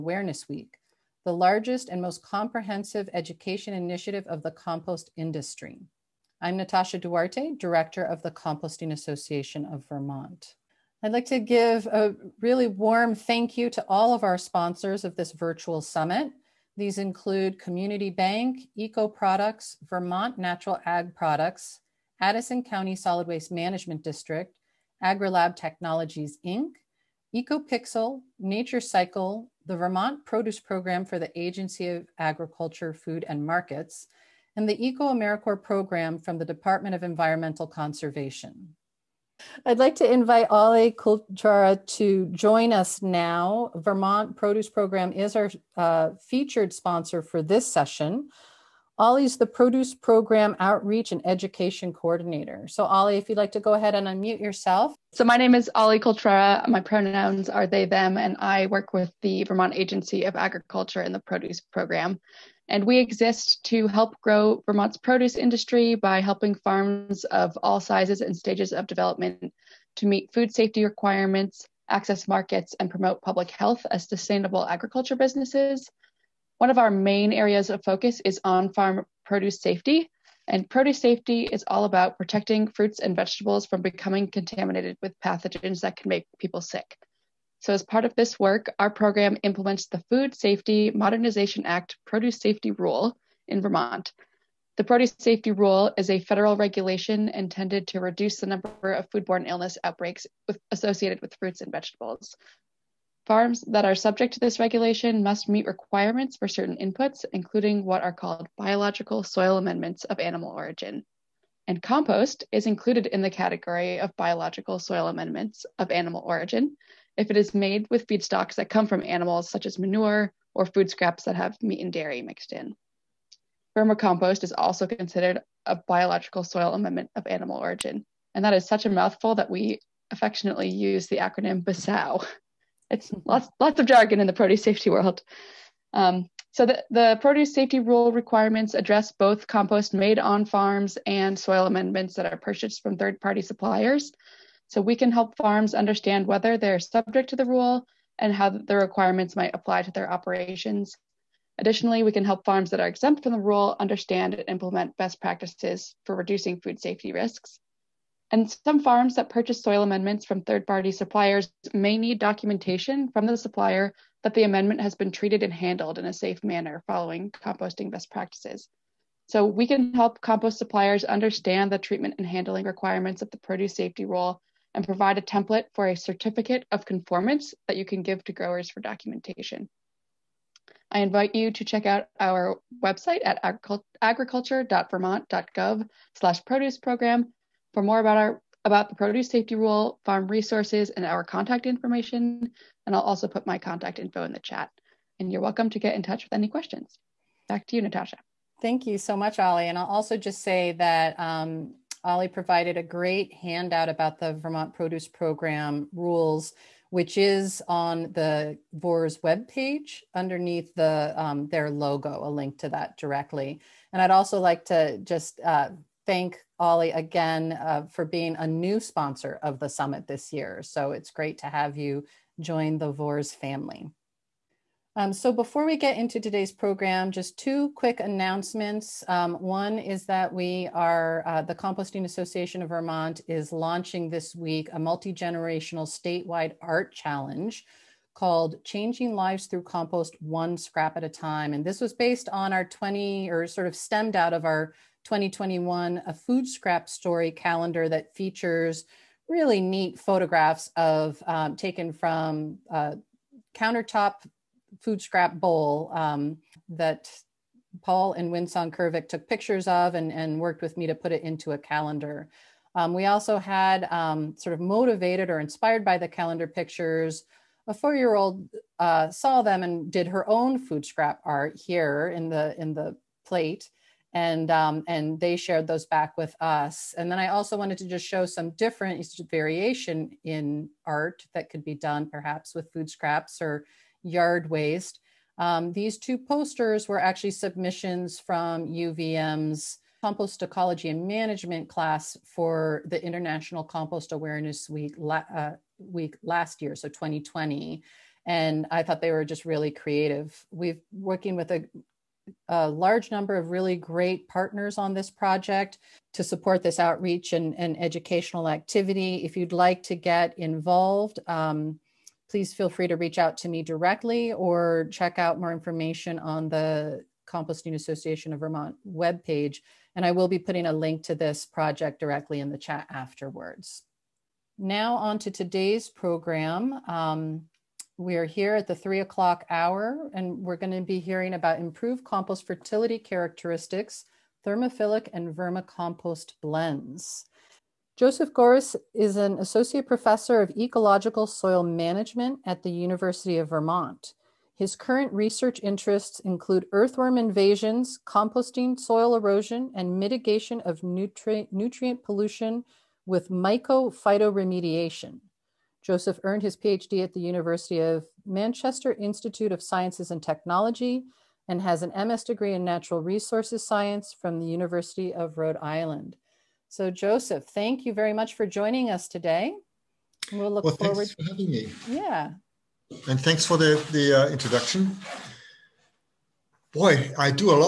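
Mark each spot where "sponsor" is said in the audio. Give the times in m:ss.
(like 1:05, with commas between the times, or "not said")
0:14, 0:46, 3:38.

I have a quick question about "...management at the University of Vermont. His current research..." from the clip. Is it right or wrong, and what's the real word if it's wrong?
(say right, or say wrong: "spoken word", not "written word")
right.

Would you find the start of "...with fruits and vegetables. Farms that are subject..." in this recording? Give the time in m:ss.
1:41.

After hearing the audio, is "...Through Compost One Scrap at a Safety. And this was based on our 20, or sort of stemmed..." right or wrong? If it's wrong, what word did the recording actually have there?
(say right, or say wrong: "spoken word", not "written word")
wrong: "Time", not "Safety".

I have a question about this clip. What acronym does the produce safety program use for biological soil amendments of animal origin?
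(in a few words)
BASAO.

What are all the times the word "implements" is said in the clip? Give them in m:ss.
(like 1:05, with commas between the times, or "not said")
1:29, 2:34.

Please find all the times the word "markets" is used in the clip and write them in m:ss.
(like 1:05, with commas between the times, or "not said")
0:33, 1:12.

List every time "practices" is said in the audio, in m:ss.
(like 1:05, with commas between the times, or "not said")
2:35, 2:48.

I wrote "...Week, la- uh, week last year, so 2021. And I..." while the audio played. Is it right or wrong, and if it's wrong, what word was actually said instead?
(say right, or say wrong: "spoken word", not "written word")
wrong: "2020", not "2021".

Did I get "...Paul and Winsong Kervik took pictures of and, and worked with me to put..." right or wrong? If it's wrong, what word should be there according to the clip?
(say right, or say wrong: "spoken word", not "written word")
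right.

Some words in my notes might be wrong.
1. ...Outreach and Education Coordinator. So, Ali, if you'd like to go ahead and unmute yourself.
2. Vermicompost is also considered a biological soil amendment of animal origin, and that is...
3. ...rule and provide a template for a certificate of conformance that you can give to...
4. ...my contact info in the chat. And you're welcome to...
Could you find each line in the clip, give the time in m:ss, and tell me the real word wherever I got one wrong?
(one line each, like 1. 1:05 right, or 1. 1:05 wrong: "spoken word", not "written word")
1. 0:50 right
2. 2:03 right
3. 2:54 right
4. 3:13 right.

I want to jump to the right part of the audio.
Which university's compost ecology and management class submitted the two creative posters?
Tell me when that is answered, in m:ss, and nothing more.
4:48.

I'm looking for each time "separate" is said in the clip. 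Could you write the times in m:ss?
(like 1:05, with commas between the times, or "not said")
not said.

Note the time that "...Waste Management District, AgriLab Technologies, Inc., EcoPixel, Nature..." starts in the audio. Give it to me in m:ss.
0:23.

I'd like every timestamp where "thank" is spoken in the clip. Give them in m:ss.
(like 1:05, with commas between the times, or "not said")
0:13, 3:18, 3:36, 6:07, 6:13.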